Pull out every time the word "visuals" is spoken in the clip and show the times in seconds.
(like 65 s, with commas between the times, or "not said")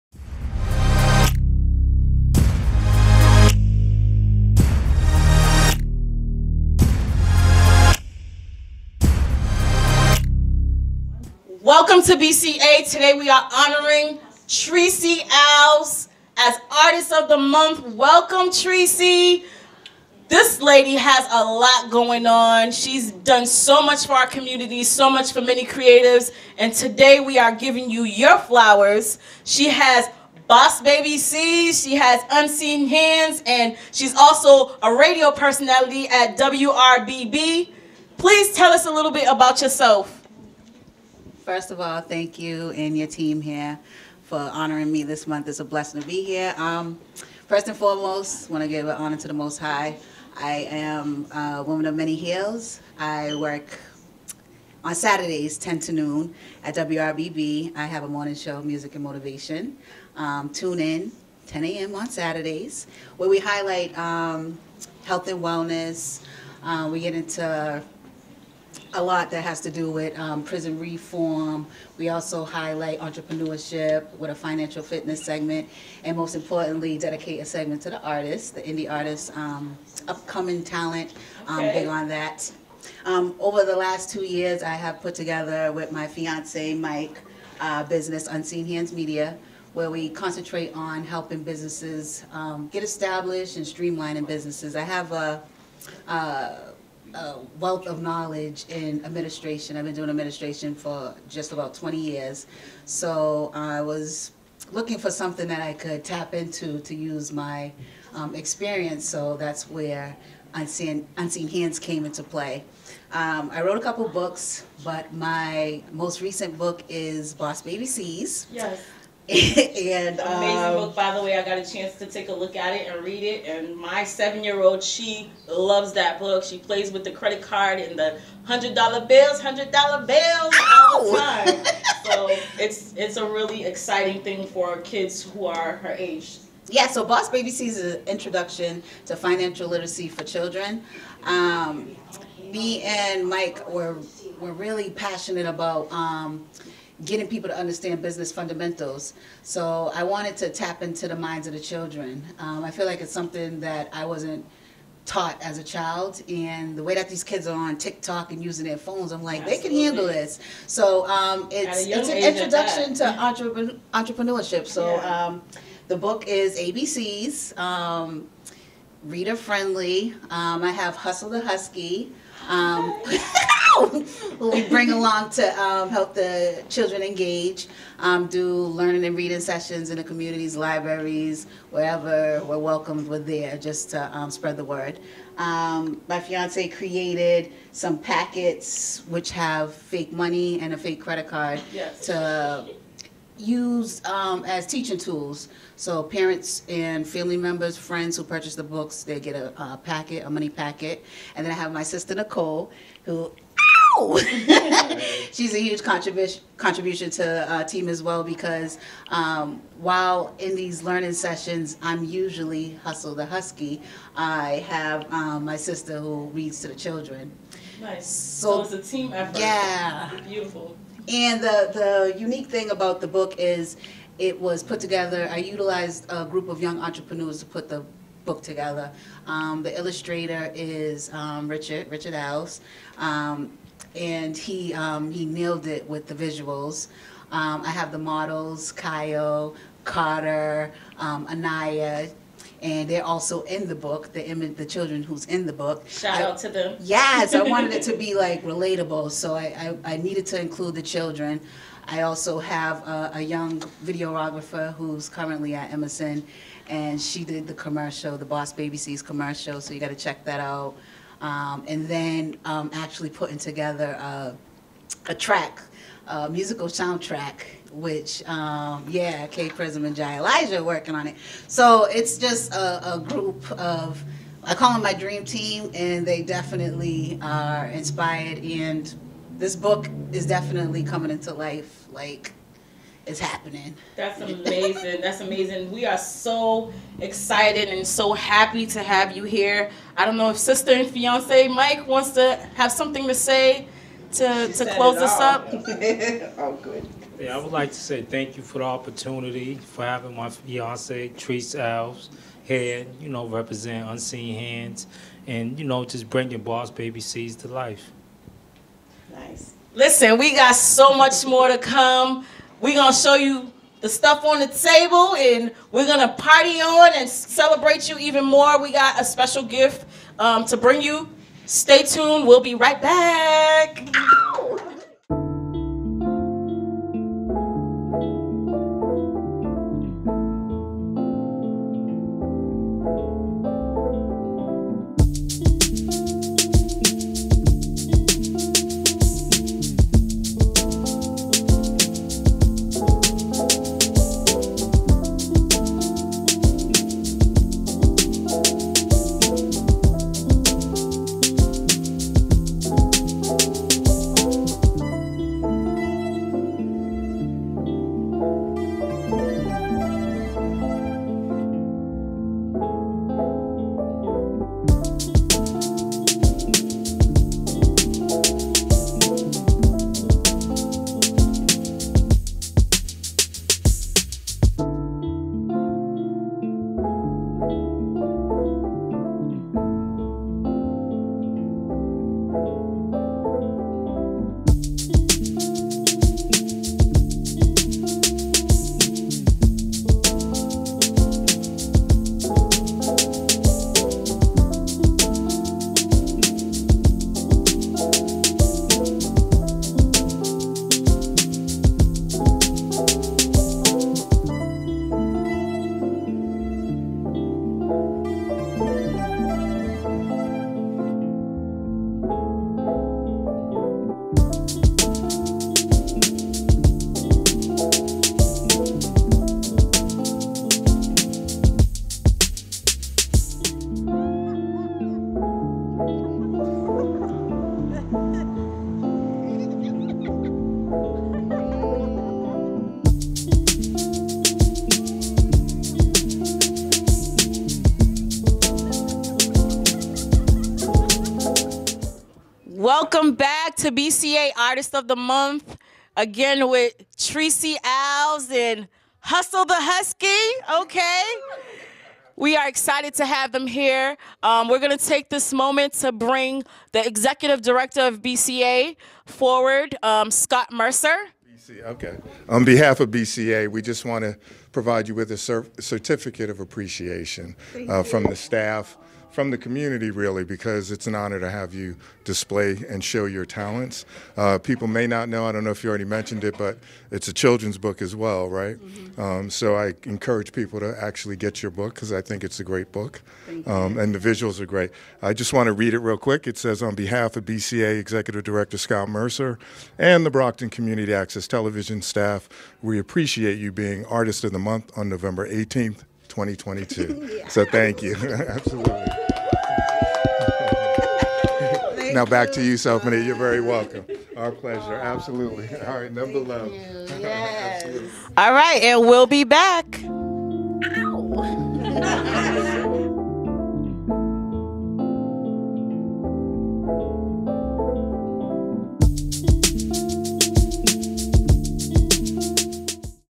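236 s, 484 s.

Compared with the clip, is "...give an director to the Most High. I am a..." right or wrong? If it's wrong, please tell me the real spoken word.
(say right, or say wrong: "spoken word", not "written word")
wrong: "honor", not "director".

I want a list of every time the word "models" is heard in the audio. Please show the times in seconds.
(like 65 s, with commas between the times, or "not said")
237 s.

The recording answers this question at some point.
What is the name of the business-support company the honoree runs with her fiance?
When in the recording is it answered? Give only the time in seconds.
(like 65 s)
88 s.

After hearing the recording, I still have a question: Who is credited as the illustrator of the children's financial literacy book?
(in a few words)
Richard Alves.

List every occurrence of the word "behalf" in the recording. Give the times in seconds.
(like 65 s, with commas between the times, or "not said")
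462 s, 486 s.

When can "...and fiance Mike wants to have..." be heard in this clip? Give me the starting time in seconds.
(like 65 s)
290 s.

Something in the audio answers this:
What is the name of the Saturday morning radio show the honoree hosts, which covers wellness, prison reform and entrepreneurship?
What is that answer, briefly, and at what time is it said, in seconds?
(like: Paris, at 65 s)
Music and Motivation, at 58 s.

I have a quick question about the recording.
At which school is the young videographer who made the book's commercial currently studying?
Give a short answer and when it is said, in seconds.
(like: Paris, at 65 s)
Emerson, at 255 s.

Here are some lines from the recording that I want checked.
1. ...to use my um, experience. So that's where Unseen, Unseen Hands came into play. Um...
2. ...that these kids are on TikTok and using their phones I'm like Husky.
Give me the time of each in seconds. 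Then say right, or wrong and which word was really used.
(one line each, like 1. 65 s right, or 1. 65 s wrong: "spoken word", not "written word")
1. 106 s right
2. 156 s wrong: "Absolutely", not "Husky".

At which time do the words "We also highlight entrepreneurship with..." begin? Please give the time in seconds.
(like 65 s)
71 s.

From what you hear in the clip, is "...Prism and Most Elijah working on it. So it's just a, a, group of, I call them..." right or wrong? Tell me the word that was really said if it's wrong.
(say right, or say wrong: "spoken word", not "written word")
wrong: "Jai", not "Most".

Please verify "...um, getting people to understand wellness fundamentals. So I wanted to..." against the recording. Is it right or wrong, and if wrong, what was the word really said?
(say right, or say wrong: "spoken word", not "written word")
wrong: "business", not "wellness".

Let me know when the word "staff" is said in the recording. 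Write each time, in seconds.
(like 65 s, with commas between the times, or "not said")
468 s, 491 s.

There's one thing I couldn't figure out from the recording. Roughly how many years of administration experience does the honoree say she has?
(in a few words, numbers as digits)
20.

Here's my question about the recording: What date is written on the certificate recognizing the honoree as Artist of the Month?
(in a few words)
November 18th, 2022.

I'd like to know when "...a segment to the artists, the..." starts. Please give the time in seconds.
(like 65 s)
77 s.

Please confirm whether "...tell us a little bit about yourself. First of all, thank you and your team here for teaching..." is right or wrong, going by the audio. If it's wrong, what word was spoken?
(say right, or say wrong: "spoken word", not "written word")
wrong: "honoring", not "teaching".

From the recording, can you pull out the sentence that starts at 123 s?
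And my seven-year-old, she loves that book.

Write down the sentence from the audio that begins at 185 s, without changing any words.
Um, my fiance created some packets which have fake money and a fake credit card yes.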